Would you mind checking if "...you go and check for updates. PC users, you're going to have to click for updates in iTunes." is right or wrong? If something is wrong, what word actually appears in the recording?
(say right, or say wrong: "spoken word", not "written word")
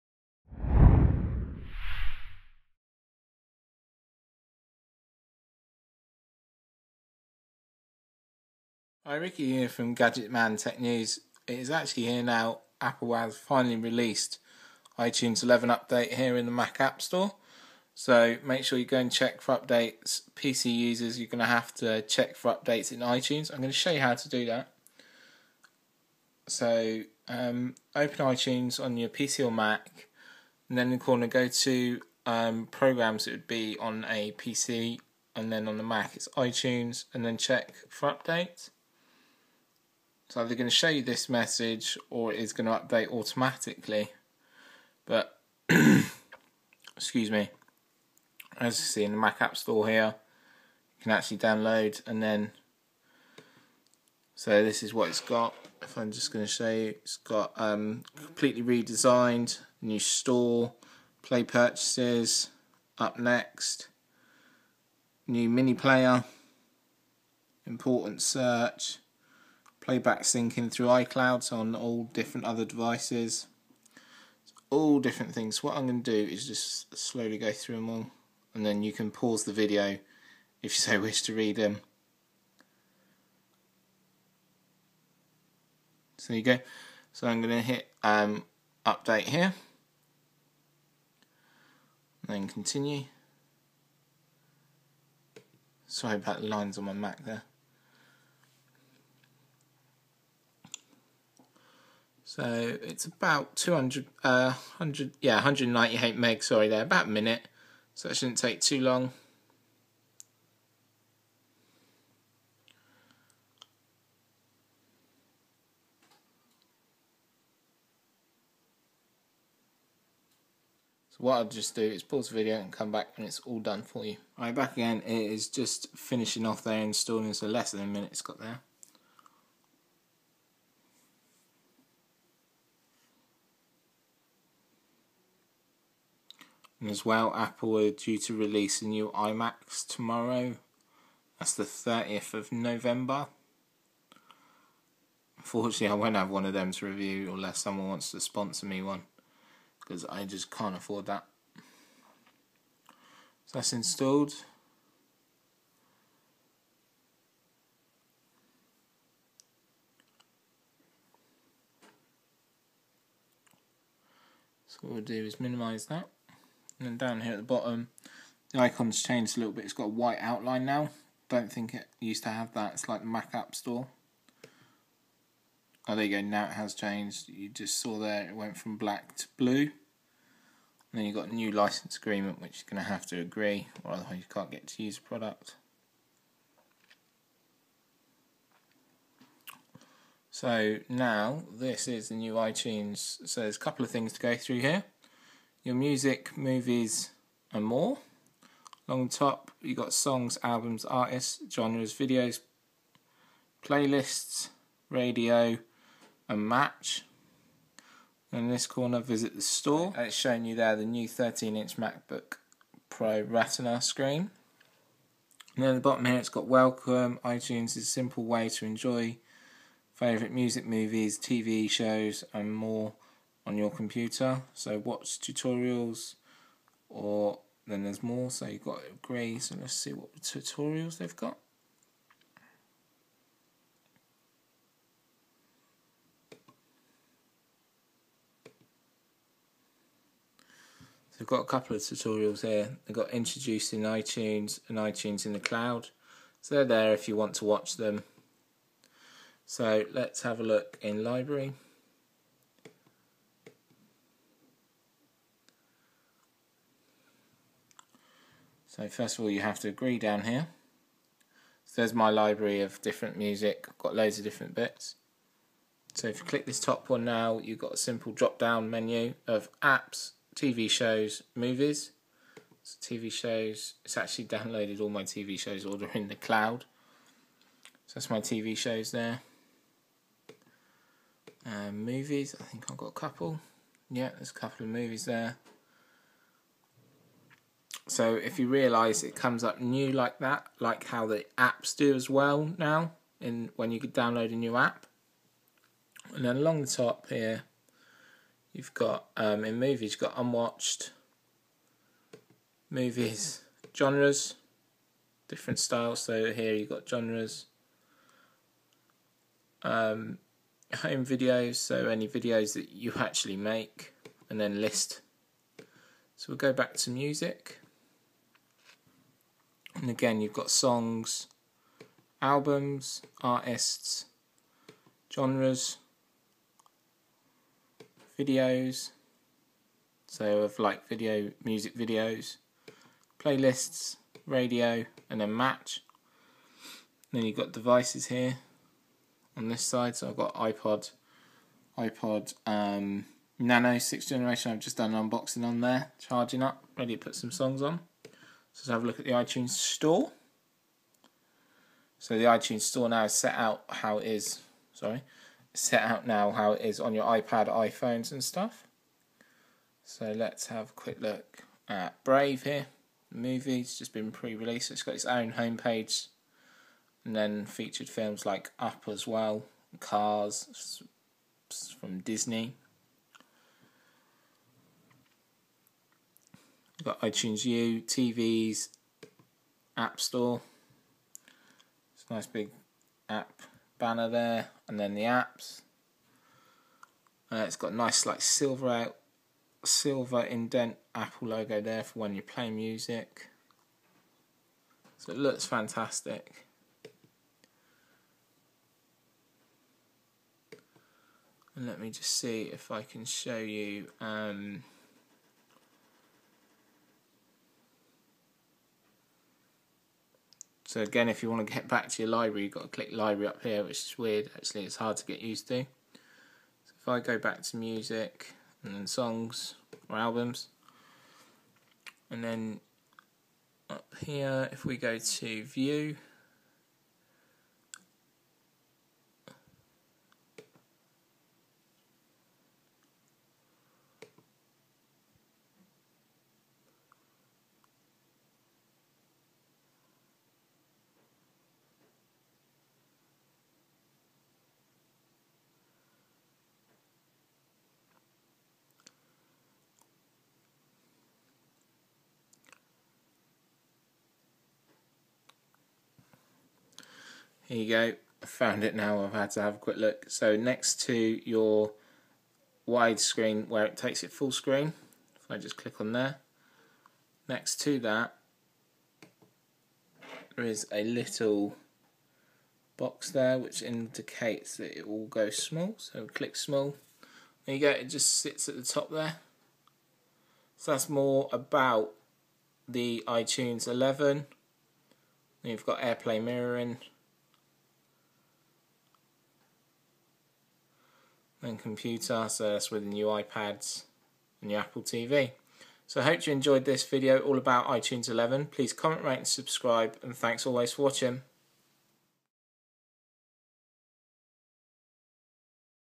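wrong: "check", not "click".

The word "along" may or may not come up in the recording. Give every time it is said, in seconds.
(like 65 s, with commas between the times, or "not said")
198 s, 296 s.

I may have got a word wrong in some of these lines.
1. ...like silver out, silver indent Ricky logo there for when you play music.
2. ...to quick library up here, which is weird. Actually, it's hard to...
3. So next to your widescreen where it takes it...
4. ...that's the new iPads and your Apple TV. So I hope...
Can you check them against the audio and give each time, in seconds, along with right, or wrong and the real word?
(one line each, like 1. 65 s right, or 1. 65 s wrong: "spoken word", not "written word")
1. 388 s wrong: "Apple", not "Ricky"
2. 412 s wrong: "click", not "quick"
3. 460 s right
4. 492 s right.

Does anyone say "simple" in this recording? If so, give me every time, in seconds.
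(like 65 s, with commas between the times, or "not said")
217 s, 267 s.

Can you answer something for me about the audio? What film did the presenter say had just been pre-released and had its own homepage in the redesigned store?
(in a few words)
Brave.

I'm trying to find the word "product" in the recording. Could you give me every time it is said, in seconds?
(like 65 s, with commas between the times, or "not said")
185 s.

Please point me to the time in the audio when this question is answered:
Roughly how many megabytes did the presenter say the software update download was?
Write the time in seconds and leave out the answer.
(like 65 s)
105 s.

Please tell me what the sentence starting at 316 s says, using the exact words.
So we'll go back to music.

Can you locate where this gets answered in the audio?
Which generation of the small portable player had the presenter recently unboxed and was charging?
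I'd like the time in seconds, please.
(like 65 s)
343 s.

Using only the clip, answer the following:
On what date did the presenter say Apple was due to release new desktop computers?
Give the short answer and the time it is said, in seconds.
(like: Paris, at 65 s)
30th of November, at 141 s.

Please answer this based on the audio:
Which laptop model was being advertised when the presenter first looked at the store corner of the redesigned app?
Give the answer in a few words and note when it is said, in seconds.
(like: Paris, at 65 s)
13 inch MacBook Pro Retina, at 211 s.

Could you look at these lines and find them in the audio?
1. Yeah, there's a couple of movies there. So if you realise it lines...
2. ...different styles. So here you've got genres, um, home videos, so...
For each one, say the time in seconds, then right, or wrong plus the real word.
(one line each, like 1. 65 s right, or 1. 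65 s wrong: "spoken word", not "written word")
1. 283 s wrong: "comes", not "lines"
2. 305 s right.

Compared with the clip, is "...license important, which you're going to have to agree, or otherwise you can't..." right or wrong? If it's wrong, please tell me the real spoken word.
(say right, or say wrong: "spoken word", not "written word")
wrong: "agreement", not "important".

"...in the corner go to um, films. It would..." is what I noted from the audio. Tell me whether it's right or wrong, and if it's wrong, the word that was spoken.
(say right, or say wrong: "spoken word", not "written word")
wrong: "programs", not "films".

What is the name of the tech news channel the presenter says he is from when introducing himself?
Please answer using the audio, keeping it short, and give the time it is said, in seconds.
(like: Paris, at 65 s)
Gadget Man Tech News, at 9 s.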